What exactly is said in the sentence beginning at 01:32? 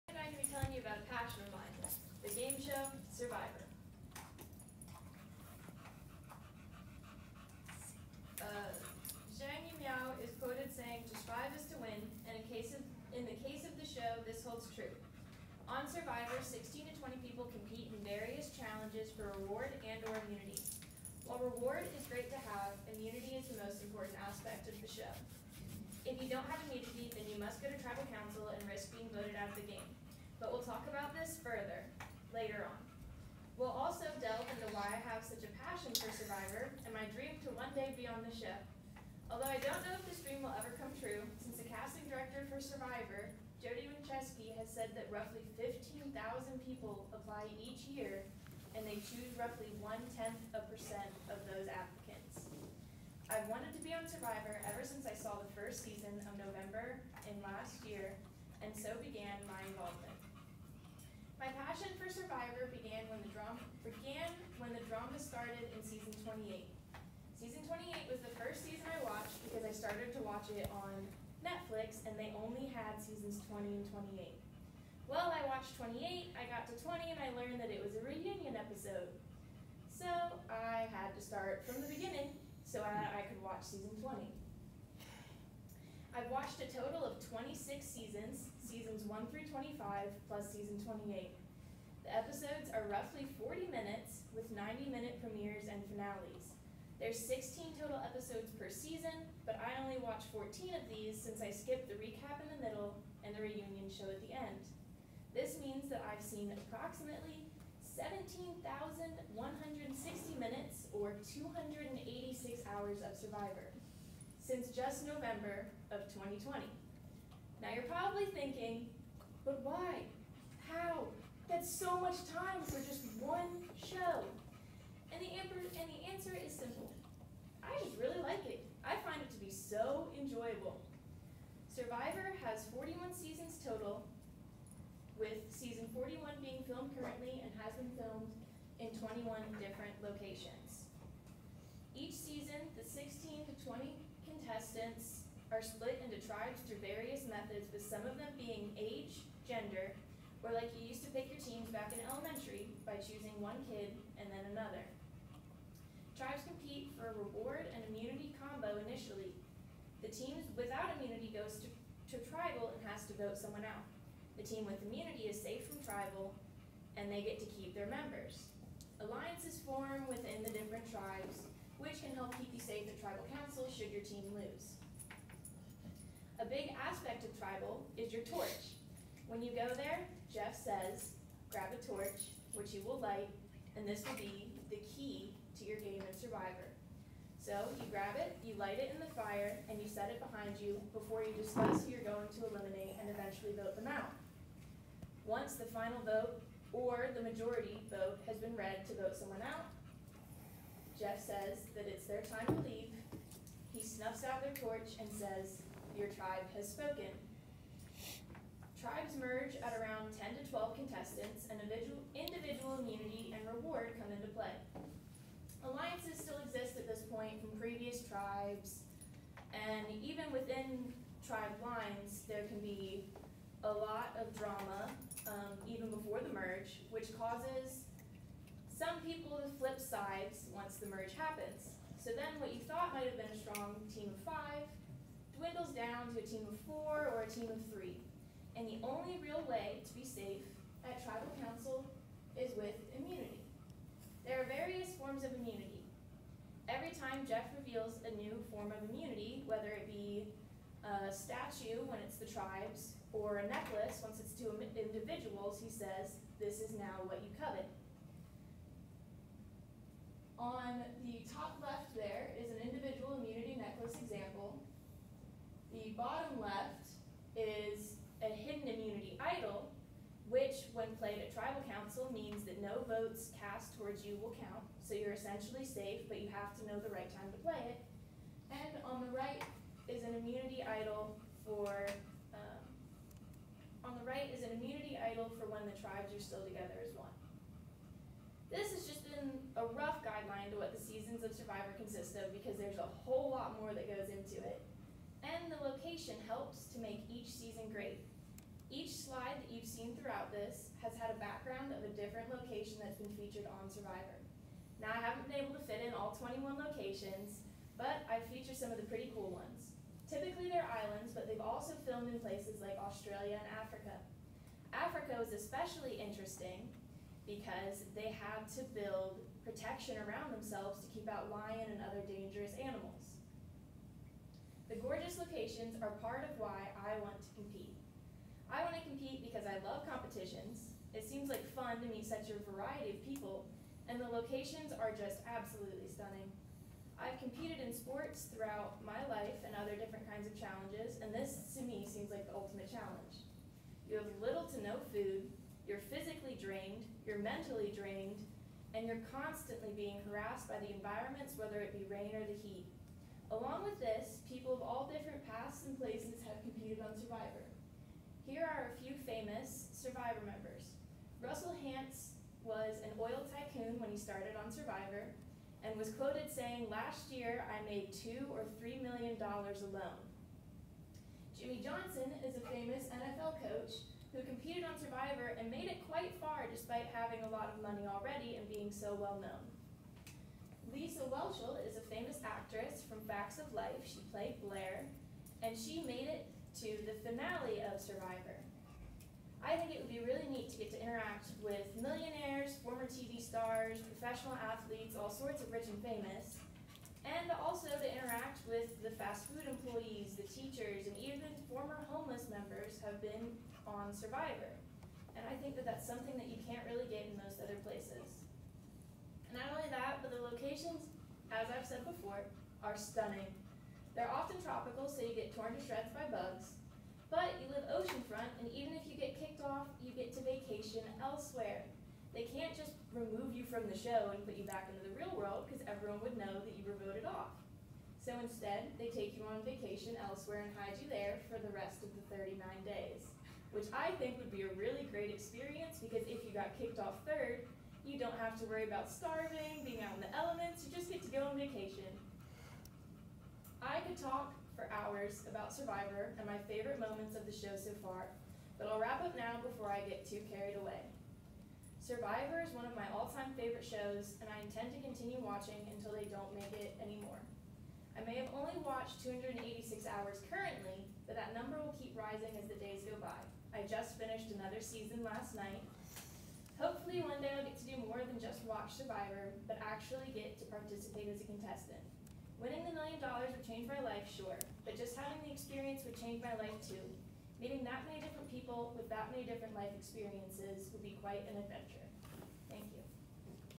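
The episodes are roughly 40 minutes with 90 minute premieres and finales.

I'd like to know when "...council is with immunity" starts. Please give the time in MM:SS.
04:01.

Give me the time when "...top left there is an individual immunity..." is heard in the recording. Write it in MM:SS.
04:21.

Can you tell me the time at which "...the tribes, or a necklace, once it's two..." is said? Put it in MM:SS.
04:12.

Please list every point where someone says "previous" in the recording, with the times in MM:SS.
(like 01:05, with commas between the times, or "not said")
03:37.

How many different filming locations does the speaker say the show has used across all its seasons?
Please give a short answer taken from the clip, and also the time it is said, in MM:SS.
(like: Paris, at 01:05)
21, at 02:19.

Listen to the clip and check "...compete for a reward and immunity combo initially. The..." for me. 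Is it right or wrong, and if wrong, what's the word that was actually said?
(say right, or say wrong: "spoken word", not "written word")
right.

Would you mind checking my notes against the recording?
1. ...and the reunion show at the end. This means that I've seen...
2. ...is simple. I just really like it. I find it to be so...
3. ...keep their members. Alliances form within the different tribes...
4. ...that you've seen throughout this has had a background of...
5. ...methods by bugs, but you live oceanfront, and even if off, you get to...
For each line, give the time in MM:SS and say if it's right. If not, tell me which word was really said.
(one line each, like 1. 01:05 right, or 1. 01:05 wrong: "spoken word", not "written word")
1. 01:43 right
2. 02:06 right
3. 02:47 right
4. 04:59 right
5. 06:55 wrong: "shreds", not "methods".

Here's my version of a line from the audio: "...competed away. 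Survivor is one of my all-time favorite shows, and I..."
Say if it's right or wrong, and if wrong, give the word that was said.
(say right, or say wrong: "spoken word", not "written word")
wrong: "carried", not "competed".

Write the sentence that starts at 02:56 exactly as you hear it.
A big aspect of tribal is your torch.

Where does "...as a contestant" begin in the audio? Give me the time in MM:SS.
07:51.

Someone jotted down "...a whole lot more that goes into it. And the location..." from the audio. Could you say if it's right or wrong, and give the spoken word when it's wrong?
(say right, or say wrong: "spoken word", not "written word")
right.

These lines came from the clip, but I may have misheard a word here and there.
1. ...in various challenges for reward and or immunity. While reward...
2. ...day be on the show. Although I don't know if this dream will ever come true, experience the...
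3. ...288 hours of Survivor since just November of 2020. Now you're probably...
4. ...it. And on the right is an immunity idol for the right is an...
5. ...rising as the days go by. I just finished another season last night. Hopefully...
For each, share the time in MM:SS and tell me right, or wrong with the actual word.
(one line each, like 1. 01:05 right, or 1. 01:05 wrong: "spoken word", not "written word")
1. 00:17 right
2. 00:37 wrong: "since", not "experience"
3. 01:51 wrong: "286", not "288"
4. 04:37 right
5. 07:41 right.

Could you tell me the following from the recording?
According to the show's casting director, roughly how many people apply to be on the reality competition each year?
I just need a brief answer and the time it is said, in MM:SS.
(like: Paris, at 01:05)
15,000, at 00:45.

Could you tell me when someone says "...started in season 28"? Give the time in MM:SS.
01:05.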